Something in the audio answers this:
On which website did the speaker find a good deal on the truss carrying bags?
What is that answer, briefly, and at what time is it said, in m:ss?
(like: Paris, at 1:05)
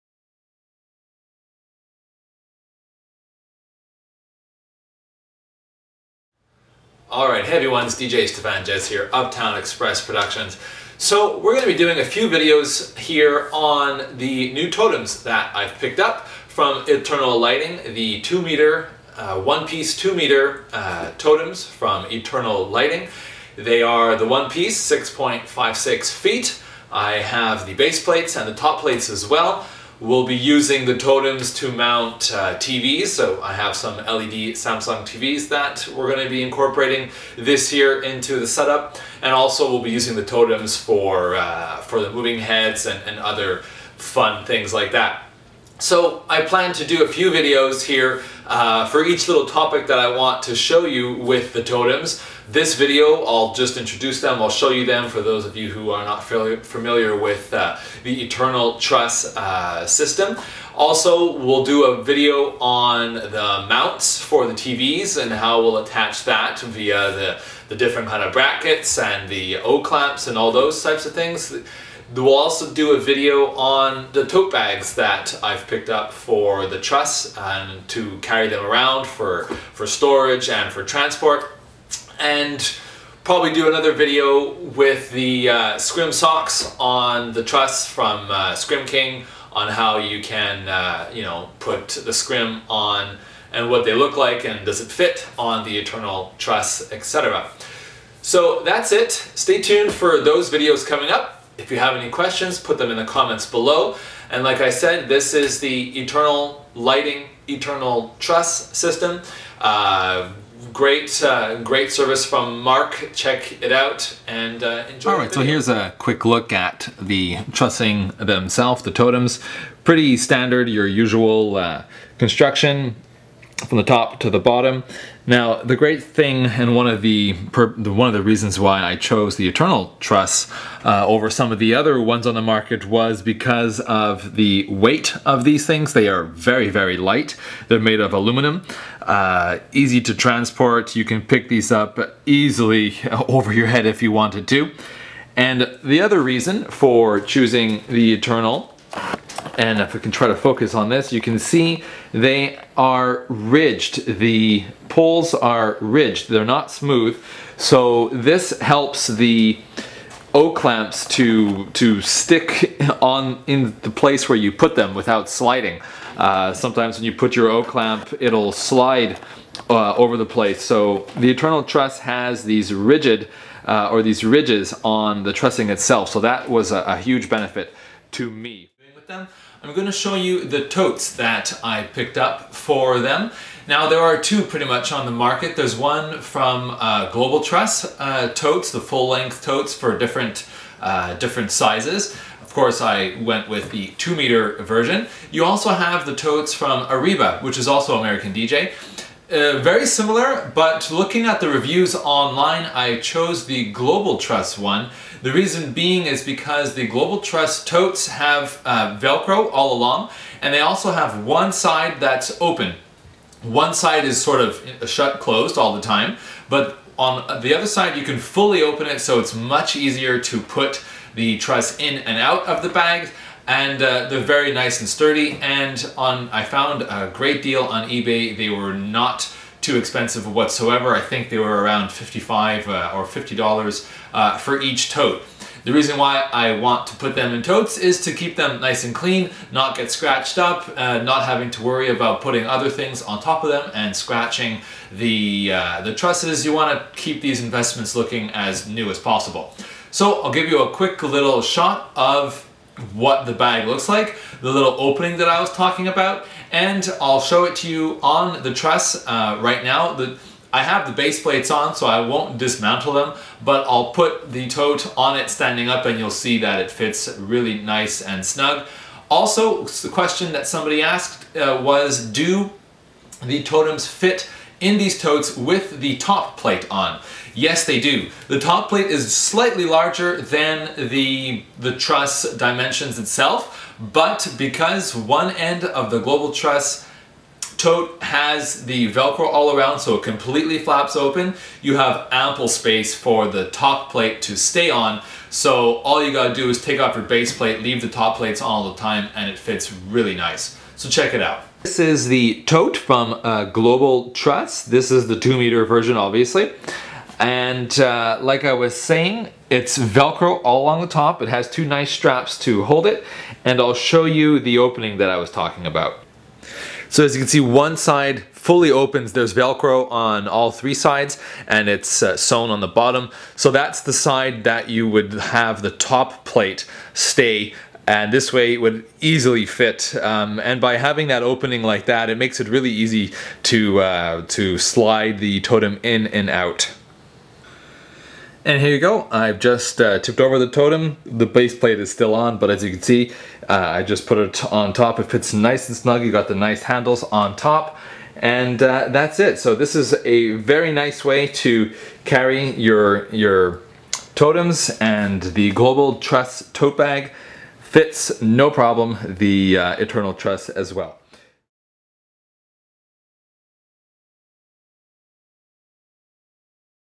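eBay, at 3:47.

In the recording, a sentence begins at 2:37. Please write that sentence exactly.
So this helps the O-clamps to, to stick on in the place where you put them without sliding.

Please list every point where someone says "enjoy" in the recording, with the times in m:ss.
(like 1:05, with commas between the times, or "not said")
1:54.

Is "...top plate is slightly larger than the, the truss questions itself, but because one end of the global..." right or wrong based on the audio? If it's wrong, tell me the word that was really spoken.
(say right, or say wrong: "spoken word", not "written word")
wrong: "dimensions", not "questions".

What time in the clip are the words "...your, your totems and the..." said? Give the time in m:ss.
5:52.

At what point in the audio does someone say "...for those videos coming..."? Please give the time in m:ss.
1:39.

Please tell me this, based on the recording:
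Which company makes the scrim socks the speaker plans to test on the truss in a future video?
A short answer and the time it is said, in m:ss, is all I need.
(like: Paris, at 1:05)
Scrim King, at 1:28.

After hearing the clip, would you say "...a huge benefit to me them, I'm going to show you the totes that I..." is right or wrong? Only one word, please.
right.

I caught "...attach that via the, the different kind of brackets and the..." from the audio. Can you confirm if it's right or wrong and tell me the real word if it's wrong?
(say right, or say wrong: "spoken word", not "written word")
right.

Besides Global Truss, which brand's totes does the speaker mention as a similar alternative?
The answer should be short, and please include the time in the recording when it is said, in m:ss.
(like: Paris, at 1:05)
Arriba, at 3:16.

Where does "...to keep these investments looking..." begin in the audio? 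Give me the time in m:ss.
4:06.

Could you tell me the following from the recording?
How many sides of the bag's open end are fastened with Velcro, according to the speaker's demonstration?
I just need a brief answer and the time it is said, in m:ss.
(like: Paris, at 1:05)
3, at 5:20.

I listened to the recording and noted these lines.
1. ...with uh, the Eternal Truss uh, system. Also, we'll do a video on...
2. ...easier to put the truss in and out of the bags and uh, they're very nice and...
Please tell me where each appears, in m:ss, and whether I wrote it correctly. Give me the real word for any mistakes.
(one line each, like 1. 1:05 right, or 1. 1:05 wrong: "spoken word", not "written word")
1. 0:57 right
2. 3:39 right.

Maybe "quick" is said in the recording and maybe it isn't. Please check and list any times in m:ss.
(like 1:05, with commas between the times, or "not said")
1:55, 4:10.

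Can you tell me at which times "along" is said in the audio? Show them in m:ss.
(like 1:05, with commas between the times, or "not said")
3:29, 5:10.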